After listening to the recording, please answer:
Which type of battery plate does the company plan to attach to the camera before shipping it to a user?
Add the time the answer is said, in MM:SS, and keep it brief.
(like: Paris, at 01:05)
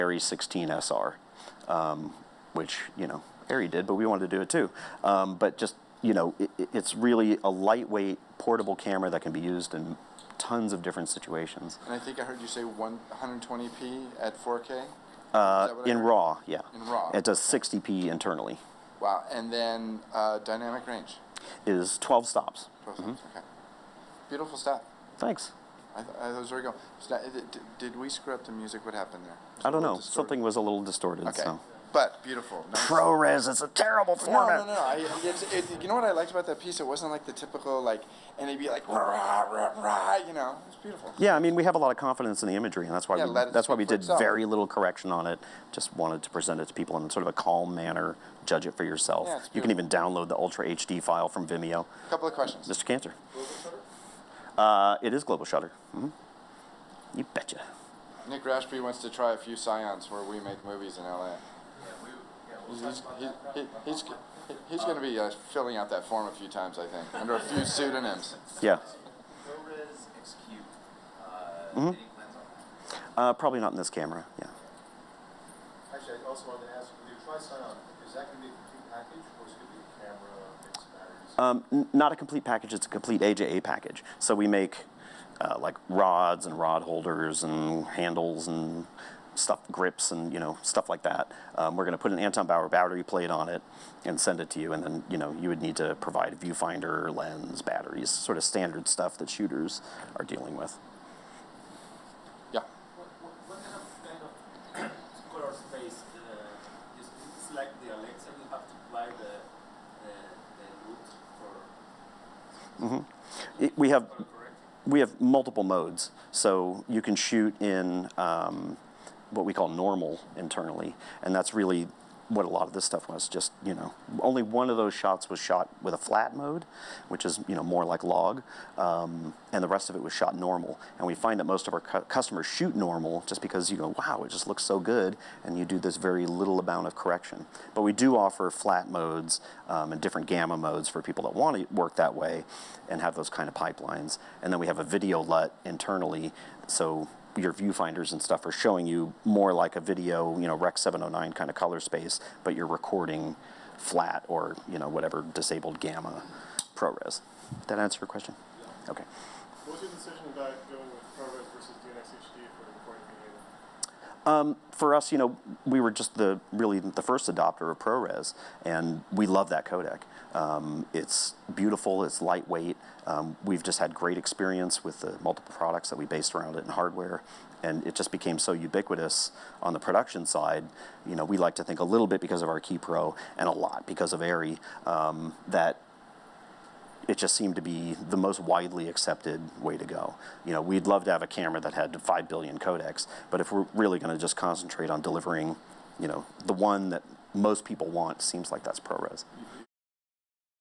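Anton Bauer, at 01:32.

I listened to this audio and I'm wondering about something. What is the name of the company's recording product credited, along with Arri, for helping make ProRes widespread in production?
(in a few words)
Ki Pro.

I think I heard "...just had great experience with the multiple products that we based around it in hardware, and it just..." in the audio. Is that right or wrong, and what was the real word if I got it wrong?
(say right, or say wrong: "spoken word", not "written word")
right.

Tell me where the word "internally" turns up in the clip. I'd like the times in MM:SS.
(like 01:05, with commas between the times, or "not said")
00:18, 02:00, 02:25.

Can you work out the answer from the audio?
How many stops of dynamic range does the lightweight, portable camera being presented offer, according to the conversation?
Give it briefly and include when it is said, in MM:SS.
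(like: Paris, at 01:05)
12, at 00:20.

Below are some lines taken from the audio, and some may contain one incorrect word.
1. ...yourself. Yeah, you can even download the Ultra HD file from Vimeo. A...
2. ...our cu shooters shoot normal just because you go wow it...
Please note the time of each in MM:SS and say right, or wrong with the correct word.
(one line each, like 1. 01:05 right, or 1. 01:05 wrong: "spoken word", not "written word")
1. 00:48 right
2. 02:11 wrong: "customers", not "shooters".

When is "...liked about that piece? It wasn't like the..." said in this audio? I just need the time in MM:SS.
00:36.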